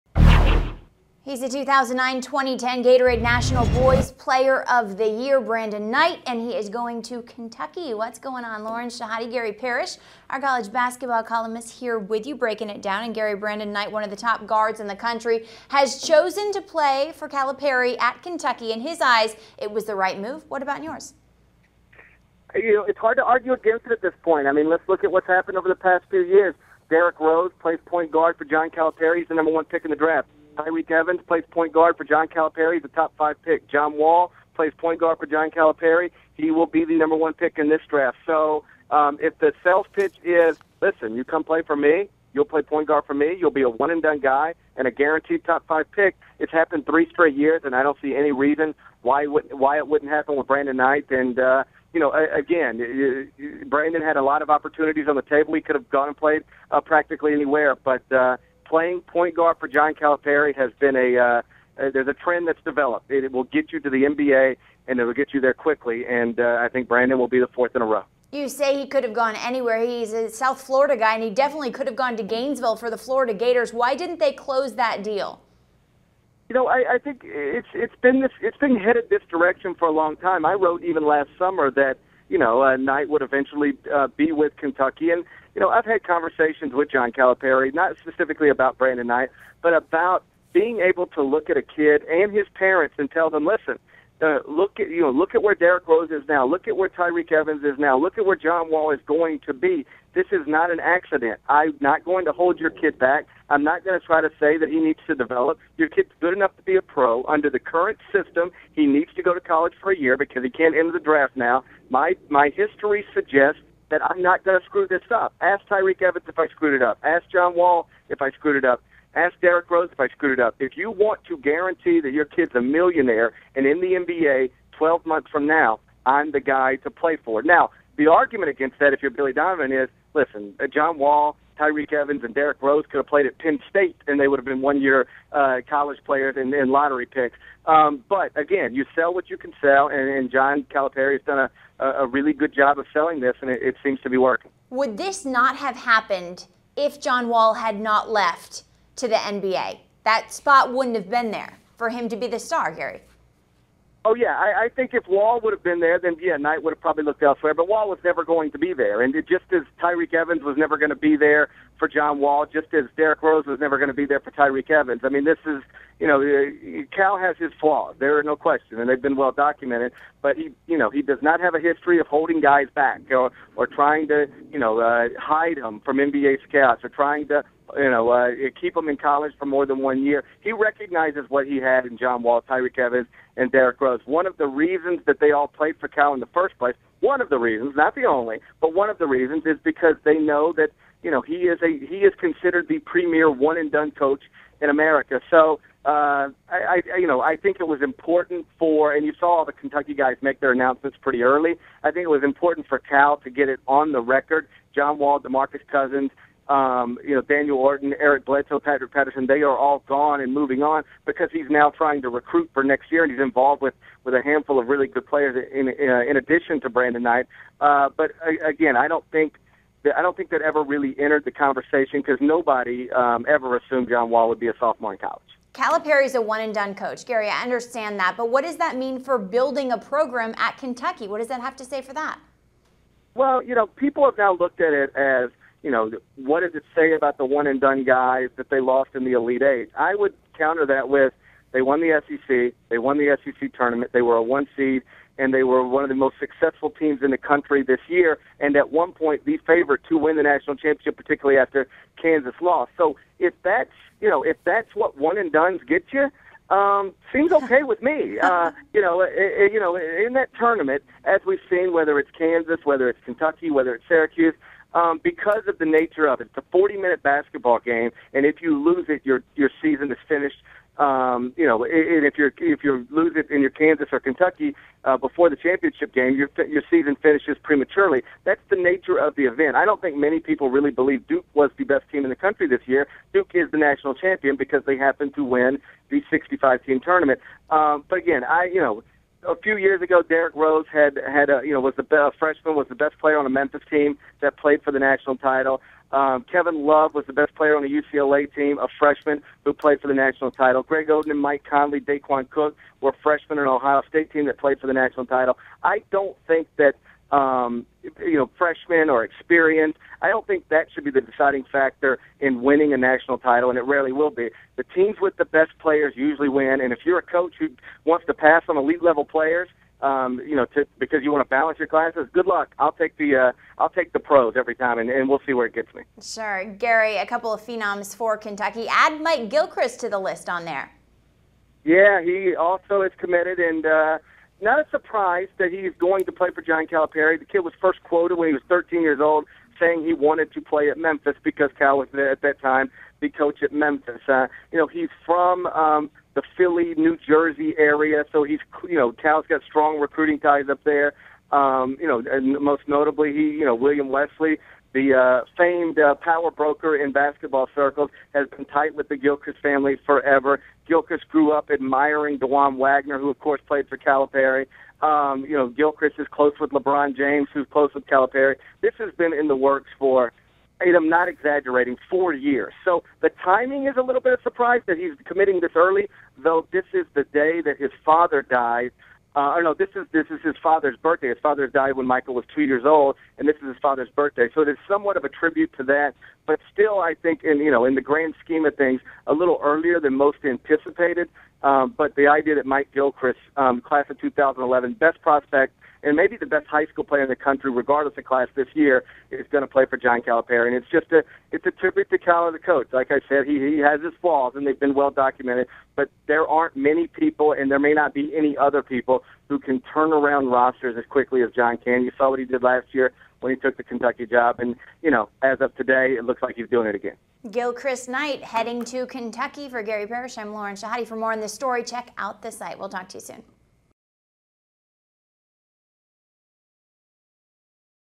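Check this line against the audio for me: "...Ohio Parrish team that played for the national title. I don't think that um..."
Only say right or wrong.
wrong.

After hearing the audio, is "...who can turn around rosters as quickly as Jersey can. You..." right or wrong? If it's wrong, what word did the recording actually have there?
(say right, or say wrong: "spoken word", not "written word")
wrong: "John", not "Jersey".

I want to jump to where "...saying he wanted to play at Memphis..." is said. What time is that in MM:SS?
05:39.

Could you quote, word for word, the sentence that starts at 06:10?
And I'm not exaggerating, four years.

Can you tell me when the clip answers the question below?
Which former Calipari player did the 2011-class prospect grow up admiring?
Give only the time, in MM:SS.
06:02.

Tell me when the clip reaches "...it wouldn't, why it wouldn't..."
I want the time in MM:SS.
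00:49.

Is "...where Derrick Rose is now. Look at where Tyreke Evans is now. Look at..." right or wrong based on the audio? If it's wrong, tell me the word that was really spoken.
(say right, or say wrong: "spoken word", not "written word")
right.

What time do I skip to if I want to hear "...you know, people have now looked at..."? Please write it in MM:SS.
03:53.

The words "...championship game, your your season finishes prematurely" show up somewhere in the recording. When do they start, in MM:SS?
04:35.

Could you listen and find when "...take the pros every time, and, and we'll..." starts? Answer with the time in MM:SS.
05:23.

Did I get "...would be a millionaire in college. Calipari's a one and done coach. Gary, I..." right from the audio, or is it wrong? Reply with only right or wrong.
wrong.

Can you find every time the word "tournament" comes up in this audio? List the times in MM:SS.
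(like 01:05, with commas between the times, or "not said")
04:03, 04:20, 04:46.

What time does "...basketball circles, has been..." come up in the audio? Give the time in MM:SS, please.
05:56.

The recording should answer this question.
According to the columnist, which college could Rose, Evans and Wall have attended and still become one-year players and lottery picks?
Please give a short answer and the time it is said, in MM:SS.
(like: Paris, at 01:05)
Penn State, at 02:13.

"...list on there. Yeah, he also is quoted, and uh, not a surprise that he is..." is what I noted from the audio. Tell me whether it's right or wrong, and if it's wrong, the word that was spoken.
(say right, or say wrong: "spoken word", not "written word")
wrong: "committed", not "quoted".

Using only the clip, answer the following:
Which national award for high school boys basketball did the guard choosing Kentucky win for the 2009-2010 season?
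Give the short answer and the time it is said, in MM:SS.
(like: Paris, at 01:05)
Gatorade National Boys Player of the Year, at 00:02.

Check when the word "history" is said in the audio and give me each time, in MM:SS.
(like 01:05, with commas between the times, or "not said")
01:52, 02:51.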